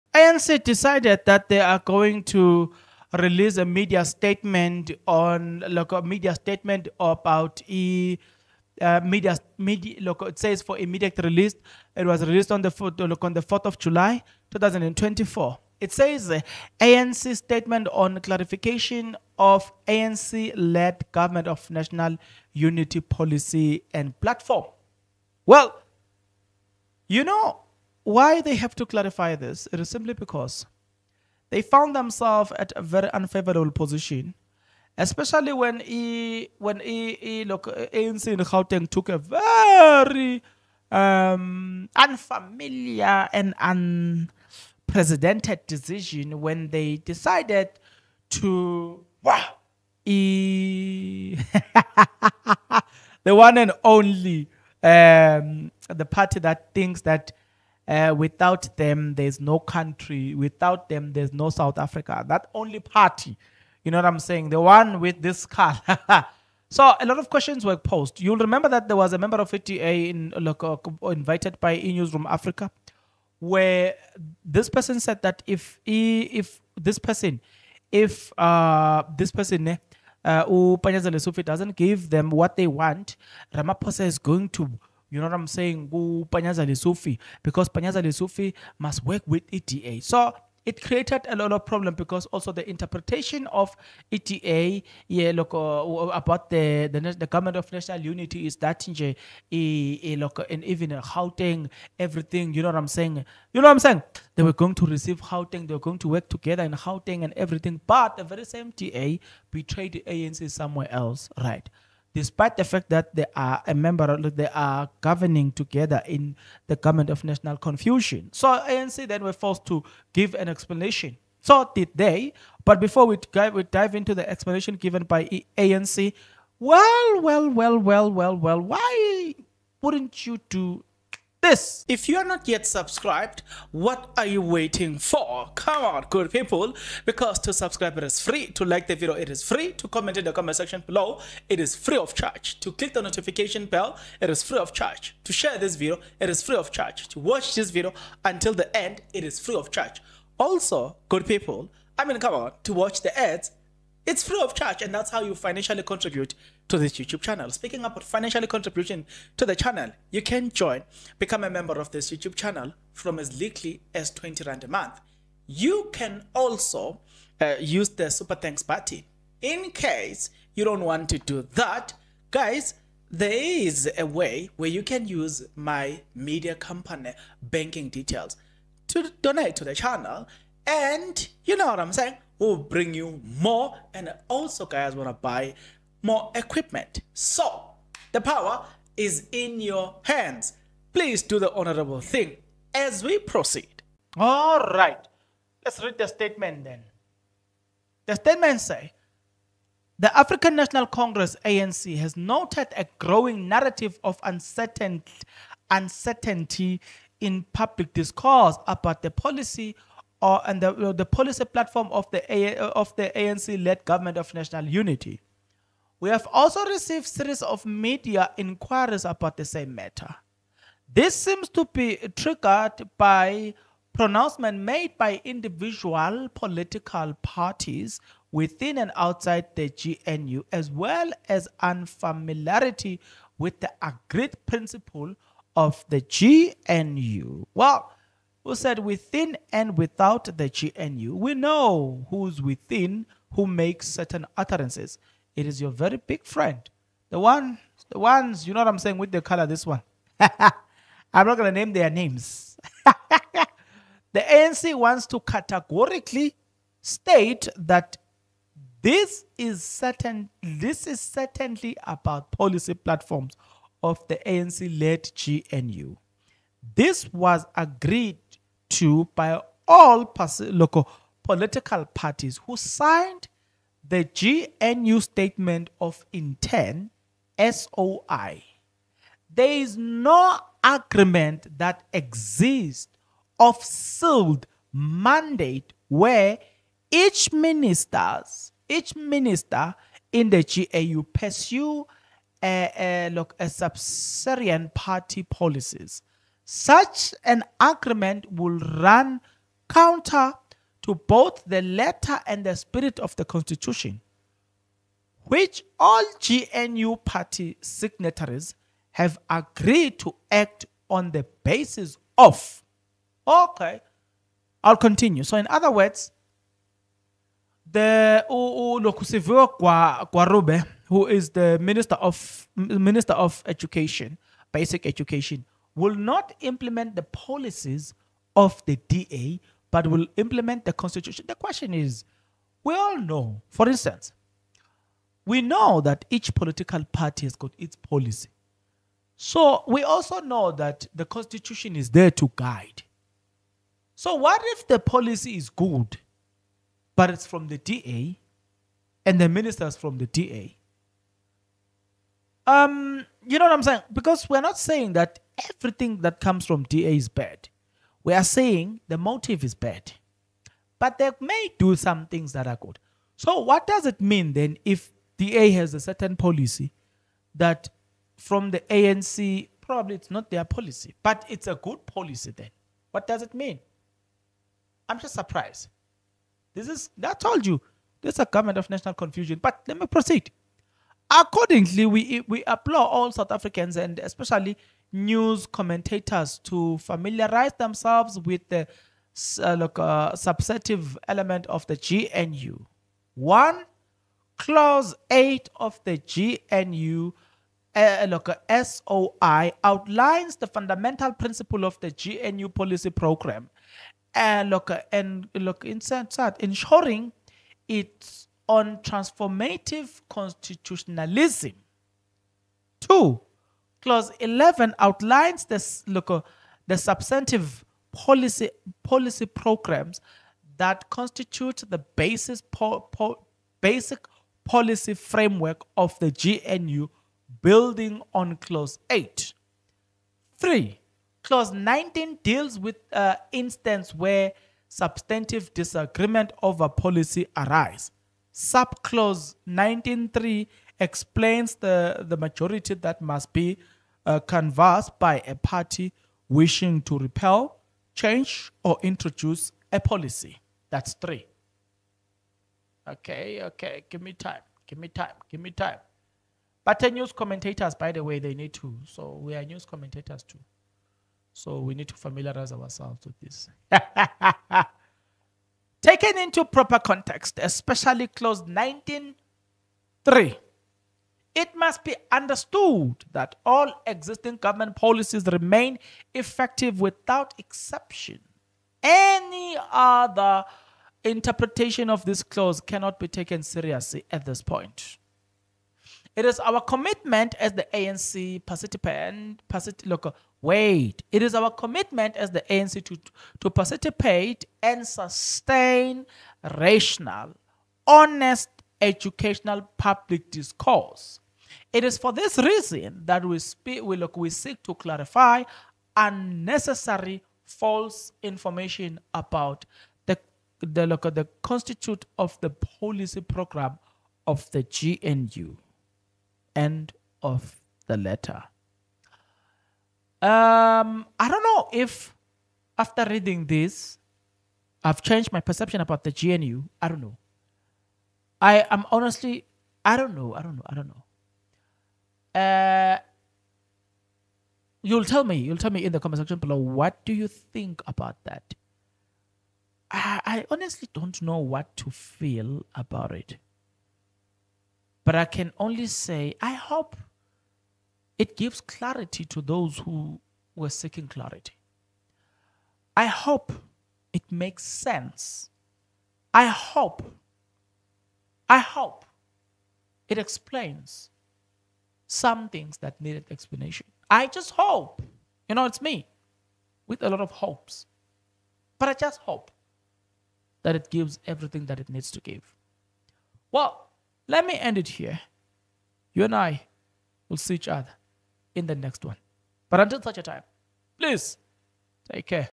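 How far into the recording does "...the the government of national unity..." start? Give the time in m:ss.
1:36.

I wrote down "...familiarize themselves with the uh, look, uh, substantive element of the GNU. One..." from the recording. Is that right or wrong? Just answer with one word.
right.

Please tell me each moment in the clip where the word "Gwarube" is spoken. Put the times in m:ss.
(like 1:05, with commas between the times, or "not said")
5:19.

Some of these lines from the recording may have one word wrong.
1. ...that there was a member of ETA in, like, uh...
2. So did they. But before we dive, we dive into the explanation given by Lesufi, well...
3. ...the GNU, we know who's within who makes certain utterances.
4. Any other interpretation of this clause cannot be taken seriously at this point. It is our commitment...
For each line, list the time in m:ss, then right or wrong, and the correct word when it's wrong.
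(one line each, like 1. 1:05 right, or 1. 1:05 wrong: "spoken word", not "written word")
1. 1:08 right
2. 2:01 wrong: "ANC", not "Lesufi"
3. 4:00 right
4. 7:58 right.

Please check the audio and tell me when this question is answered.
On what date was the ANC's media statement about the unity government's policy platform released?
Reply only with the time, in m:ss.
0:13.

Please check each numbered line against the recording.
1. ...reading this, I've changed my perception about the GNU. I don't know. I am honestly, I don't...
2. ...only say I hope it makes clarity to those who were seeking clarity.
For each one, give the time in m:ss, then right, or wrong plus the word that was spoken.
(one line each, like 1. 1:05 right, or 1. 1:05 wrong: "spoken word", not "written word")
1. 8:43 right
2. 9:05 wrong: "gives", not "makes".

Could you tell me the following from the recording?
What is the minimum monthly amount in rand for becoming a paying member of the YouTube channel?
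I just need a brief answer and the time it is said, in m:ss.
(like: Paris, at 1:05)
20 Rand, at 2:44.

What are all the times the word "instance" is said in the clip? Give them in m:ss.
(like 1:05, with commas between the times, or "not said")
5:33, 7:13.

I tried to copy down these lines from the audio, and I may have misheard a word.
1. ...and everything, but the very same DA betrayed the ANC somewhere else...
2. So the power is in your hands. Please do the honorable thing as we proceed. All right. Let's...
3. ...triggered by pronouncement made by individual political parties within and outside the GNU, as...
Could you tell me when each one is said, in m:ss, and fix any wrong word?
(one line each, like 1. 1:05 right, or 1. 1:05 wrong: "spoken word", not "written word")
1. 1:47 right
2. 3:07 right
3. 3:42 right.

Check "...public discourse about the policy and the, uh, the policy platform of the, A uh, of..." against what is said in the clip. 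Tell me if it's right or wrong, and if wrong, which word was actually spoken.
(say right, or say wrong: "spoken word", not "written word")
right.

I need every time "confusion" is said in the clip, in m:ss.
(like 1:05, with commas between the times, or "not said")
1:57, 6:18.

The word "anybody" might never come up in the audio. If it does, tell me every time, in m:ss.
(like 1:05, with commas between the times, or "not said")
not said.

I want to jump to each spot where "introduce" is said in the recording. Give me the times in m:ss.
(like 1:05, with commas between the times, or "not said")
7:28.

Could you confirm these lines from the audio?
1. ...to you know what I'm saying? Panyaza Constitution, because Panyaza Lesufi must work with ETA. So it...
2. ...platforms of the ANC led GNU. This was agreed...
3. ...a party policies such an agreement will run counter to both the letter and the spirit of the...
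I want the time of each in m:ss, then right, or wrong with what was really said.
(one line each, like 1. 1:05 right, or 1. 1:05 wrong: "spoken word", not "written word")
1. 1:24 wrong: "Lesufi", not "Constitution"
2. 4:22 right
3. 4:53 right.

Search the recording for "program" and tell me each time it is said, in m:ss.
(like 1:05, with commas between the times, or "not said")
6:42, 6:59, 8:33.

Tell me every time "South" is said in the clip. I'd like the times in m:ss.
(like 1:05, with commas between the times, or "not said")
1:01, 6:23.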